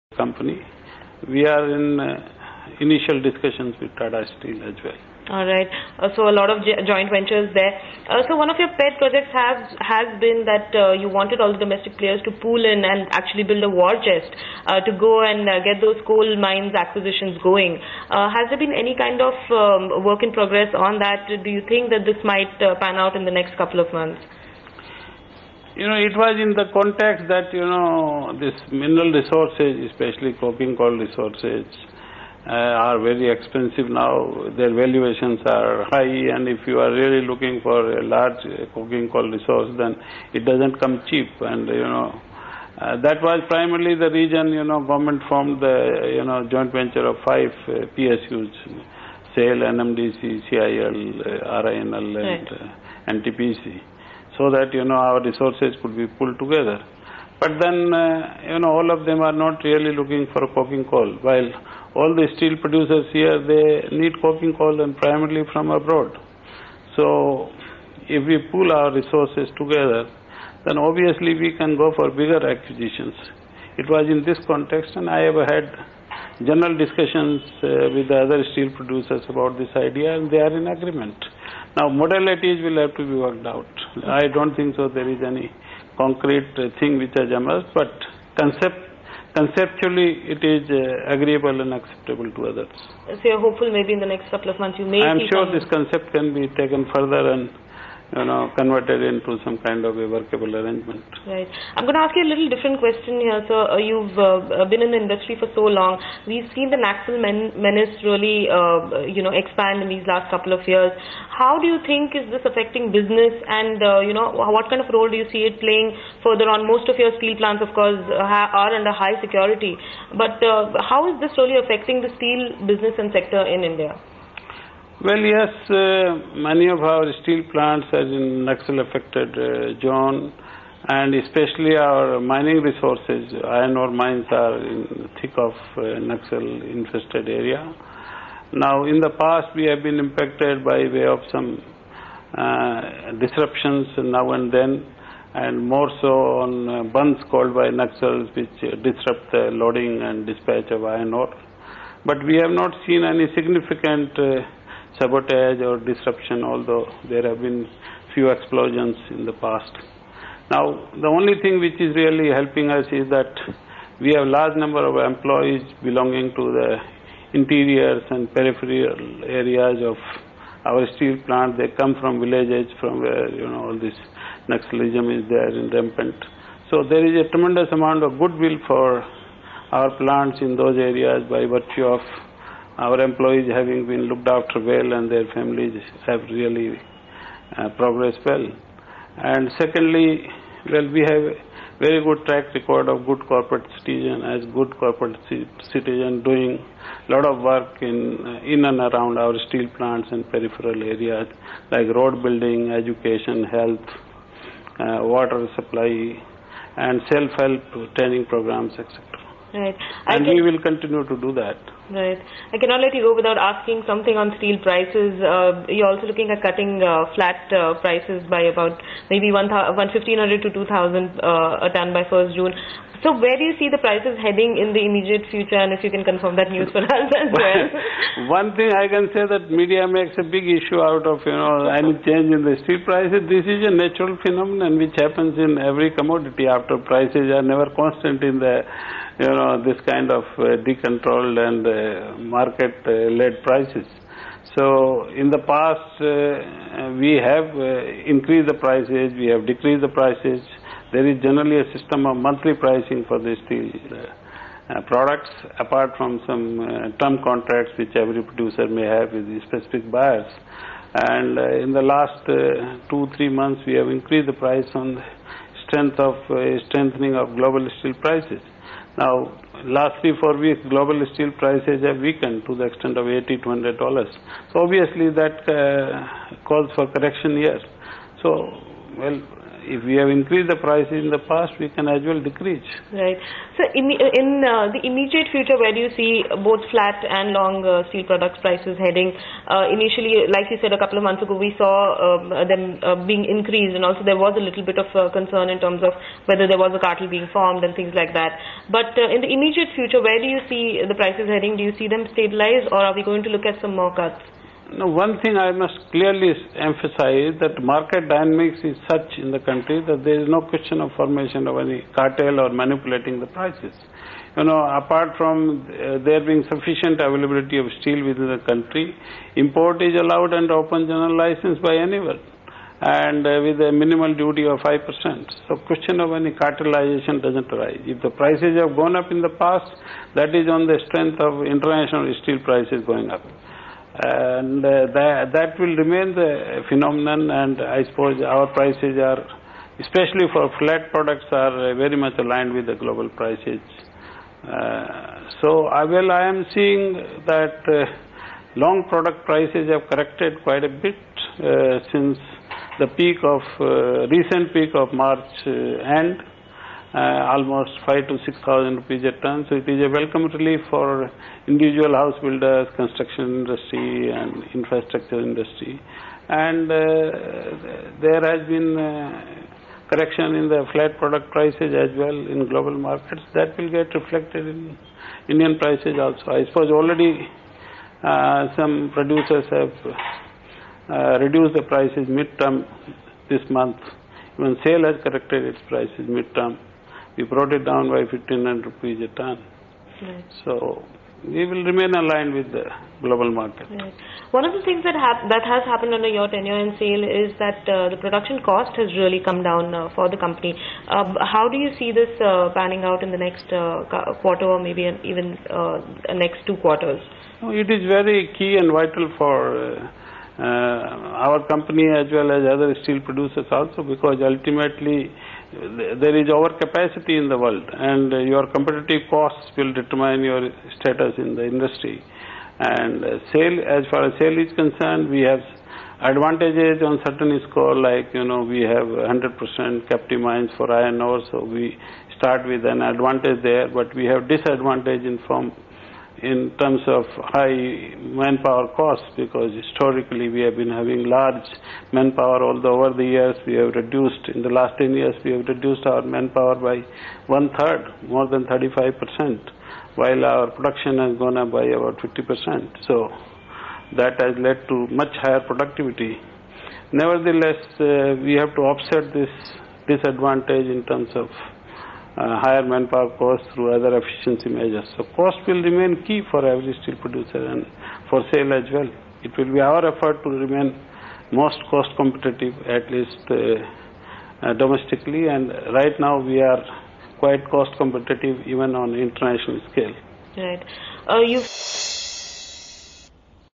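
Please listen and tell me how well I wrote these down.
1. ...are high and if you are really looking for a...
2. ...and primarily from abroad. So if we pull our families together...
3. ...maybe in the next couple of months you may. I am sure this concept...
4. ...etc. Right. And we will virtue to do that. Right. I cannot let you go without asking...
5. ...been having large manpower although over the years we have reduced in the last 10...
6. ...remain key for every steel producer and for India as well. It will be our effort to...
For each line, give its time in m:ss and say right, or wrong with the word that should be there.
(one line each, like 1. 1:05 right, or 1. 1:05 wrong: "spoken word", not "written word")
1. 0:35 right
2. 1:04 wrong: "resources", not "families"
3. 1:33 right
4. 3:28 wrong: "continue", not "virtue"
5. 7:20 right
6. 7:45 wrong: "SAIL", not "India".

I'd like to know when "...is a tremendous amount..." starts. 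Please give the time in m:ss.
2:57.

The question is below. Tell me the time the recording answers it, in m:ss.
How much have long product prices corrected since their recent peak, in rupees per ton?
5:57.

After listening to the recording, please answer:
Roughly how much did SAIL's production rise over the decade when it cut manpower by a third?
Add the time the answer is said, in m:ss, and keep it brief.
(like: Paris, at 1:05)
About 50 percent, at 7:31.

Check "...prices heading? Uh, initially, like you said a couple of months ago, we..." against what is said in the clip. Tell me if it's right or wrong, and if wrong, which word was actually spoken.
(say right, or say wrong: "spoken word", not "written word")
right.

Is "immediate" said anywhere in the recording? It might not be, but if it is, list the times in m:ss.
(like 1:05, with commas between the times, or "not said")
3:44, 4:44, 4:59.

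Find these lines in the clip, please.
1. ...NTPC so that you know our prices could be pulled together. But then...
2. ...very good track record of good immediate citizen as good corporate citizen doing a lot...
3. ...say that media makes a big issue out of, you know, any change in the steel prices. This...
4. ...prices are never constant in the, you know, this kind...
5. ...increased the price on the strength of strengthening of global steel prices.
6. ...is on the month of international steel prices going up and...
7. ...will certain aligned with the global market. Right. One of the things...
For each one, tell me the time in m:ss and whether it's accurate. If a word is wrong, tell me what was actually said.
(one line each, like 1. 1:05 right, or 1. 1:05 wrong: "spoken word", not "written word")
1. 0:53 wrong: "resources", not "prices"
2. 3:11 wrong: "corporate", not "immediate"
3. 3:49 right
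4. 3:56 right
5. 4:23 right
6. 5:30 wrong: "strength", not "month"
7. 6:31 wrong: "remain", not "certain".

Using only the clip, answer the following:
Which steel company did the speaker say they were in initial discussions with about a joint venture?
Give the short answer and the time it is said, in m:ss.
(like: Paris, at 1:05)
Tata Steel, at 0:03.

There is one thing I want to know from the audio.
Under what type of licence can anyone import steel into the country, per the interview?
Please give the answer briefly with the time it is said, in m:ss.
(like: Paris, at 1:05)
Open general license, at 5:20.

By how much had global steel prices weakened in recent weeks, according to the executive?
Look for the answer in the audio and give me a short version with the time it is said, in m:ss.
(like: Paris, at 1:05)
80 to 100 dollars, at 4:33.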